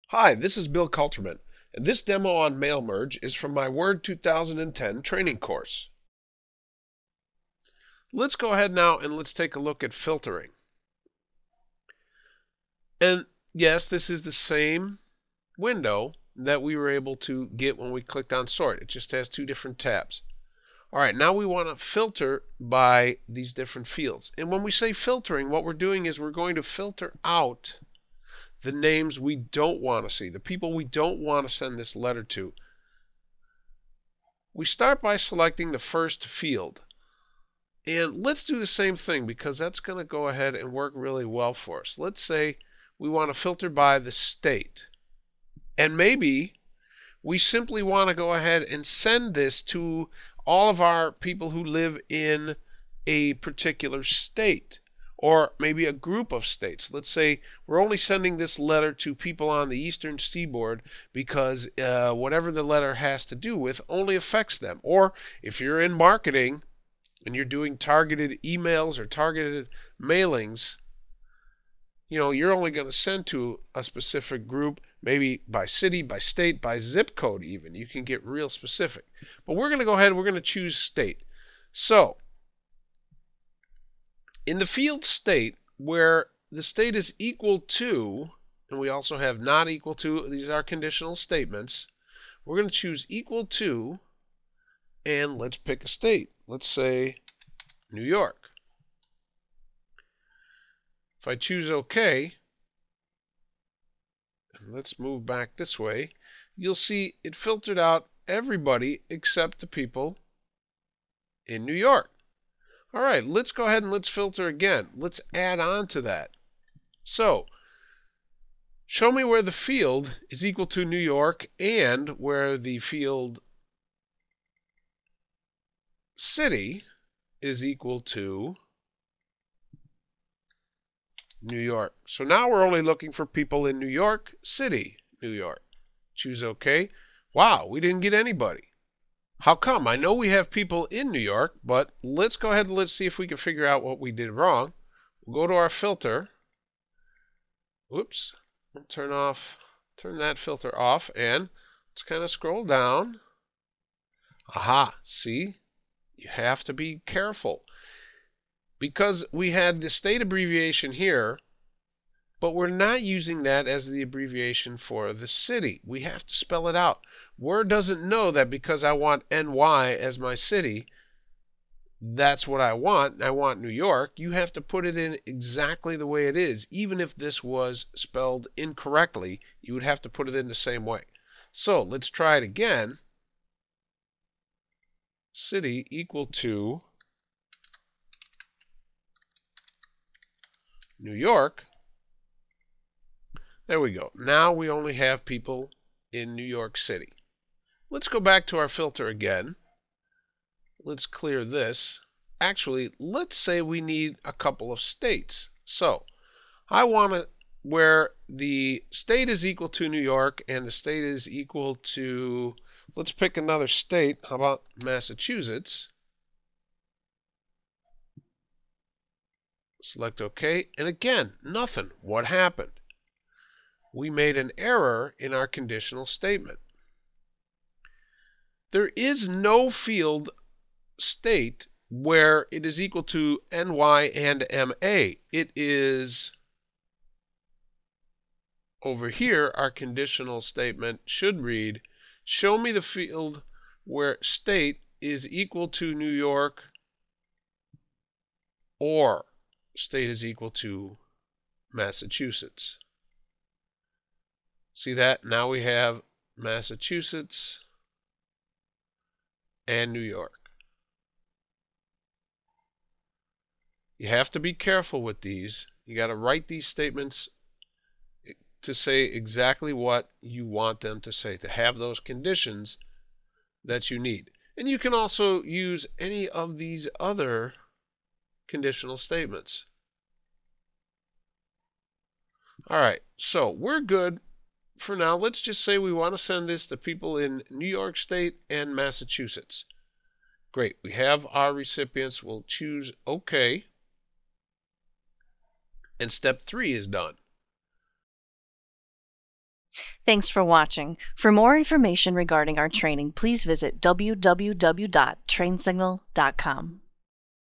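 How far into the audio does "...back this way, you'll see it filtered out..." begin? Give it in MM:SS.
01:45.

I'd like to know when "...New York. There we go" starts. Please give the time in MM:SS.
03:10.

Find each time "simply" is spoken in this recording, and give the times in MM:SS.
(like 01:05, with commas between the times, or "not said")
00:47.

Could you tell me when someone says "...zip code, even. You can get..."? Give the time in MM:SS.
01:16.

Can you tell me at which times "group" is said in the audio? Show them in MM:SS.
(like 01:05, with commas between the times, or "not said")
00:55, 01:14.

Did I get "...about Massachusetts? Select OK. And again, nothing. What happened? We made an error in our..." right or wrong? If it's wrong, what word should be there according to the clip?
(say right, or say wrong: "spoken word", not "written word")
right.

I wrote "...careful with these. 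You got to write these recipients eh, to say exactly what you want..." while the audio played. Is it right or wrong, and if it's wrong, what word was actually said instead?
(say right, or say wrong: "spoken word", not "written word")
wrong: "statements", not "recipients".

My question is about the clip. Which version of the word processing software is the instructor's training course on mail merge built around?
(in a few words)
Word 2010.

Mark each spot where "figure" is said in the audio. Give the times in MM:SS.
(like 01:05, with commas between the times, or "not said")
02:23.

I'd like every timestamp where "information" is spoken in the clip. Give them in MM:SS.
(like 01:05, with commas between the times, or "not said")
05:01.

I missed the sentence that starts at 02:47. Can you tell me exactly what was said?
Word doesn't know that because I want NY as my city, that's what I want.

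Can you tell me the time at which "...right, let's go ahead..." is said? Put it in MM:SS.
01:53.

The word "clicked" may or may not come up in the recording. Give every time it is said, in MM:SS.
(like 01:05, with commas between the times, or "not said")
00:18.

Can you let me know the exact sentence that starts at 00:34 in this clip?
We start by selecting the first field.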